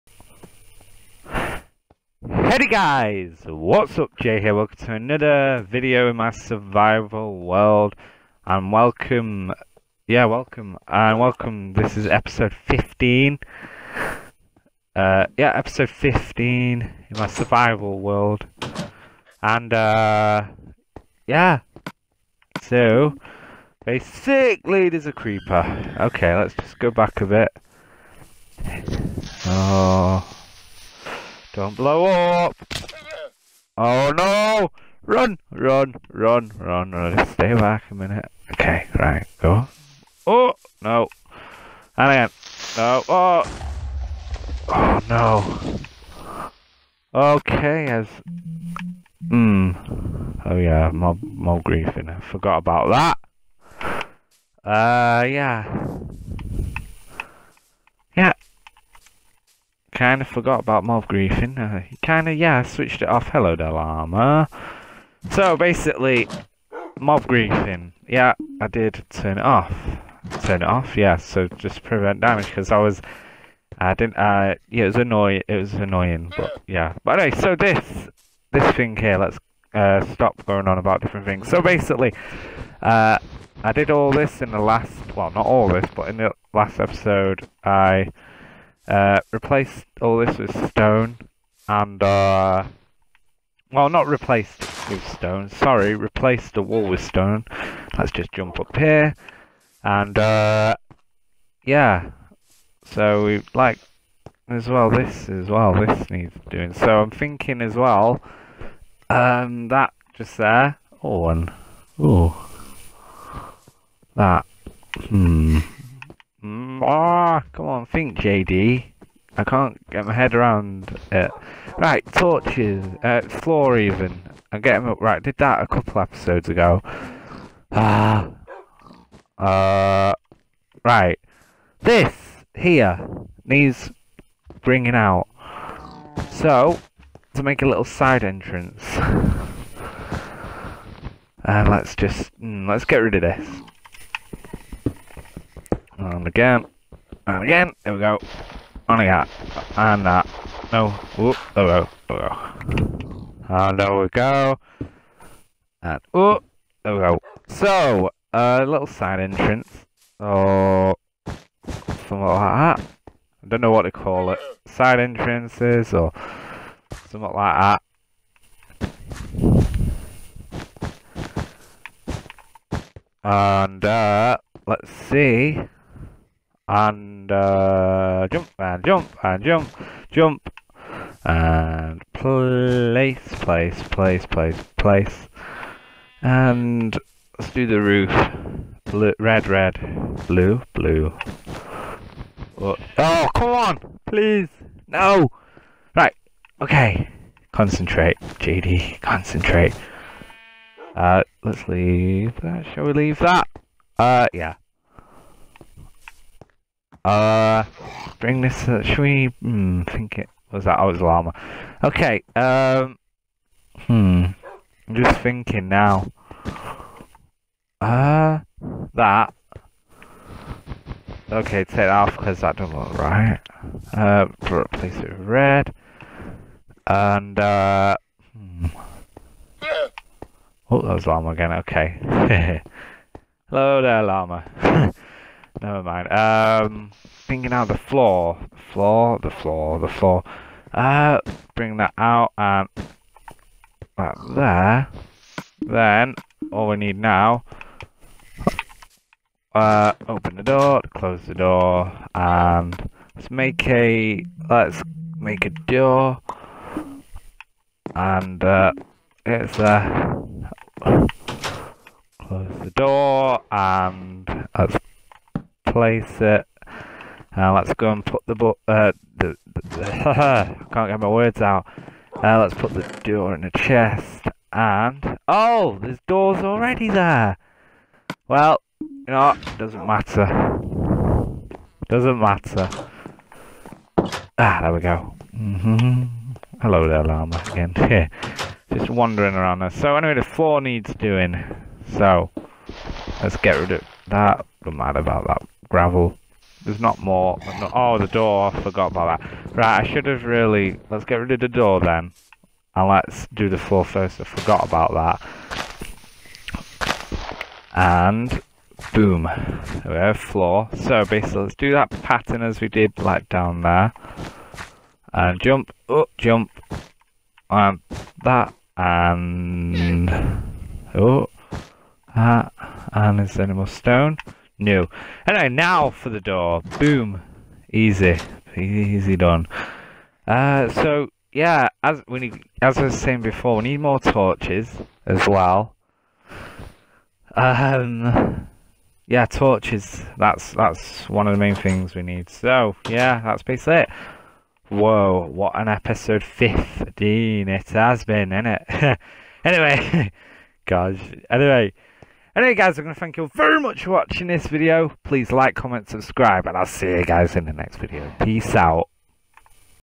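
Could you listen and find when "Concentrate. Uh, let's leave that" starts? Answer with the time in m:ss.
3:19.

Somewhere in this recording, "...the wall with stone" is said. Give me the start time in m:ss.
1:36.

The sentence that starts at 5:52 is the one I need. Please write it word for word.
Anyway guys, I'm going to thank you very much for watching this video.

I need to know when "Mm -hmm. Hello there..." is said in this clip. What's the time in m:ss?
4:45.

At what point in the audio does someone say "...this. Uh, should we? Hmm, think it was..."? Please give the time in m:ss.
3:28.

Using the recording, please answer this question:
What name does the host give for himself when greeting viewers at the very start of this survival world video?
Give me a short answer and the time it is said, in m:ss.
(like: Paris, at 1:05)
Jay, at 0:04.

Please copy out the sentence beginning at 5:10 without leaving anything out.
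So basically, let's do that pattern as we did, like, down there.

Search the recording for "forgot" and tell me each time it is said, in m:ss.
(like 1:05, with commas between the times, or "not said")
0:52, 1:00, 4:58, 5:04.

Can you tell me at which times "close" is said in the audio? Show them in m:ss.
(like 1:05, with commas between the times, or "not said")
4:10, 4:22.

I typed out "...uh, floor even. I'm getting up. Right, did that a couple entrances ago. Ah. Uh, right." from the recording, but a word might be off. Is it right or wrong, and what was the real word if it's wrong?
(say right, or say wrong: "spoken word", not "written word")
wrong: "episodes", not "entrances".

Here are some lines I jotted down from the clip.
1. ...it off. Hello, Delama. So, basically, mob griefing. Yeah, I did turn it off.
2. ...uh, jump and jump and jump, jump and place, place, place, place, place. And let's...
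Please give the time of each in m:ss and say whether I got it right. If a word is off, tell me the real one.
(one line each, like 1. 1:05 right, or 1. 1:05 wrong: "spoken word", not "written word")
1. 1:03 right
2. 2:57 right.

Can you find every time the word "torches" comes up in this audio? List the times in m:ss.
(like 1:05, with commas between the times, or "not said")
2:02, 5:33, 5:39.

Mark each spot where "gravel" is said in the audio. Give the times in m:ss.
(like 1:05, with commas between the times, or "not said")
4:55.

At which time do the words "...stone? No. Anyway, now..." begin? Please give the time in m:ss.
5:23.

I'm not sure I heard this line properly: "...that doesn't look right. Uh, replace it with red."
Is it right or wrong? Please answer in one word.
right.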